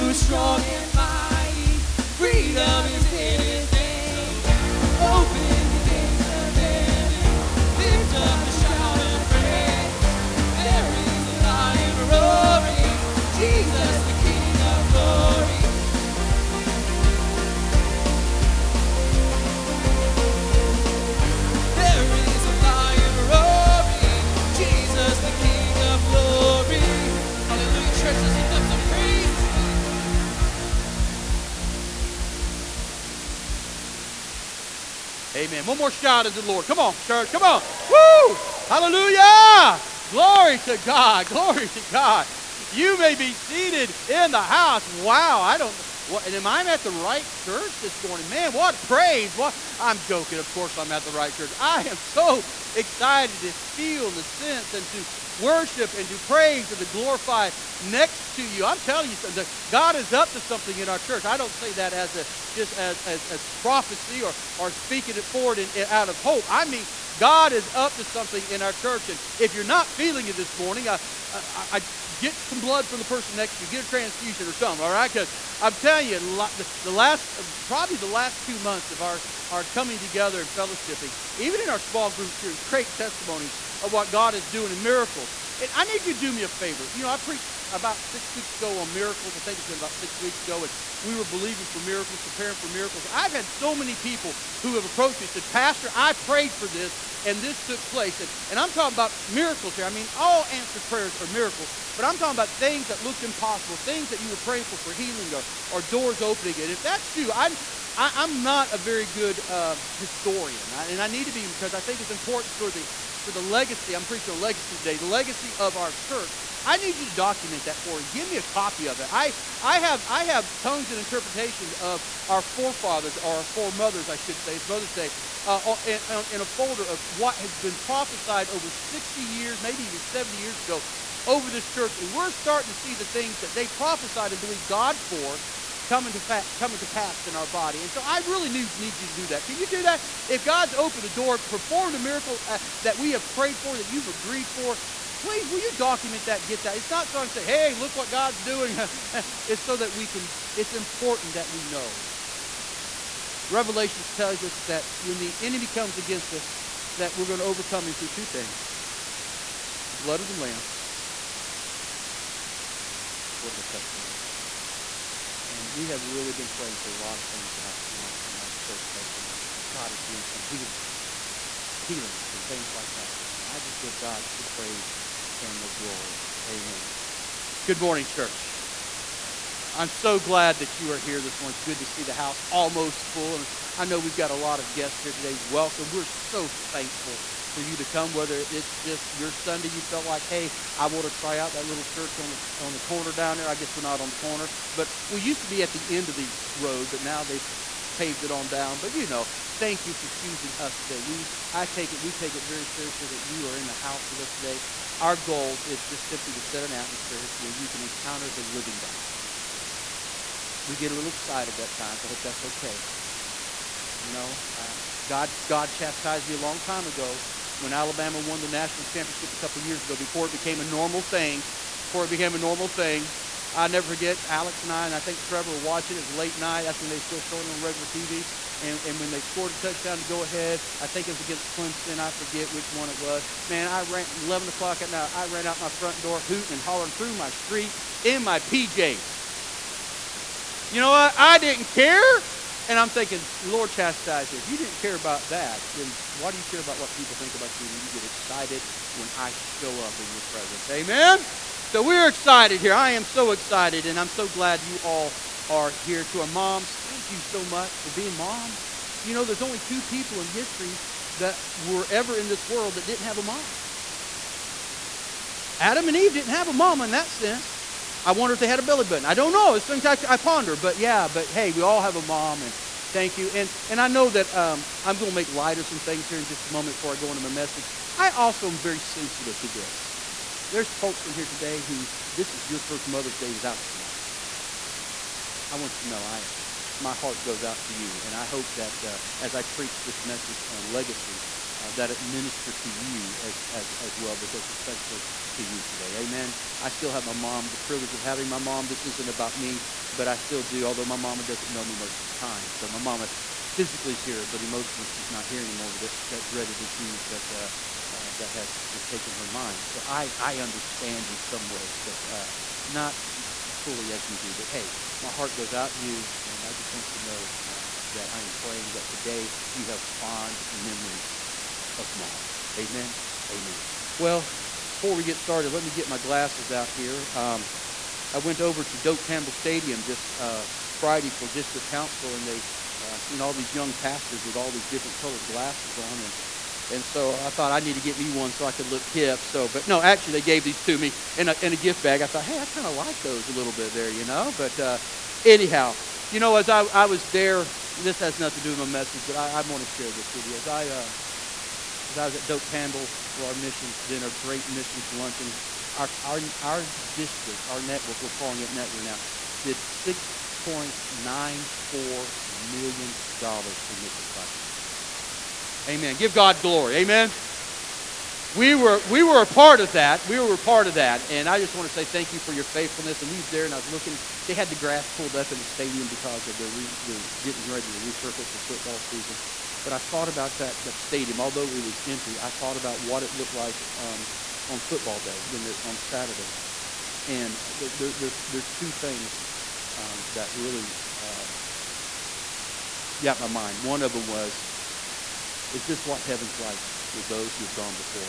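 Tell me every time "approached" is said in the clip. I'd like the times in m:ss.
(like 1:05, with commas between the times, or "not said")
1:34.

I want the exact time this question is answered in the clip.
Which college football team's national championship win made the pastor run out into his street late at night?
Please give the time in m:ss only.
3:37.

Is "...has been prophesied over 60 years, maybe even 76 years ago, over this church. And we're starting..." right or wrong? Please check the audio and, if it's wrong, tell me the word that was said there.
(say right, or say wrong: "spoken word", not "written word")
wrong: "70", not "76".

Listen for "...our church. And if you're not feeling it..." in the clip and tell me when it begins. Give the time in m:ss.
1:08.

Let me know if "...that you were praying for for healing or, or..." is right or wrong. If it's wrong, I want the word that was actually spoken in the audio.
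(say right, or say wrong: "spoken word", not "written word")
right.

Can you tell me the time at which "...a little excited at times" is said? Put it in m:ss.
3:30.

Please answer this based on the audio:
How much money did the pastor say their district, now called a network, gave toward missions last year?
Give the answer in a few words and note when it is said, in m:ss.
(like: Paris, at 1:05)
$6.94 million, at 5:59.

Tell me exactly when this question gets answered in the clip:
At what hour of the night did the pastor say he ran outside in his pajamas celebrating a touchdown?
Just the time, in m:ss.
3:54.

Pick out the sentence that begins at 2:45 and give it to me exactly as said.
And we have really been praying for a lot of things in our, in our, in our church lately.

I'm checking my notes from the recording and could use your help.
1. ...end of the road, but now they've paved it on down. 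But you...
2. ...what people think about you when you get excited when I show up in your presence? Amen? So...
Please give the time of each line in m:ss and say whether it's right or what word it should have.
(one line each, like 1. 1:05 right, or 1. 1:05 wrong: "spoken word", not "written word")
1. 3:15 right
2. 4:06 right.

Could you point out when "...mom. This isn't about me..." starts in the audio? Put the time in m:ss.
4:58.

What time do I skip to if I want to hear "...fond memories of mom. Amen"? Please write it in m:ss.
5:19.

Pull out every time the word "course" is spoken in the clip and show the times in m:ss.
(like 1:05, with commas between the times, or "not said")
0:50.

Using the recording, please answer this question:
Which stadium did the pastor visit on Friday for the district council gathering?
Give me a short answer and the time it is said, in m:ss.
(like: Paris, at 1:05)
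Doak Campbell Stadium, at 5:28.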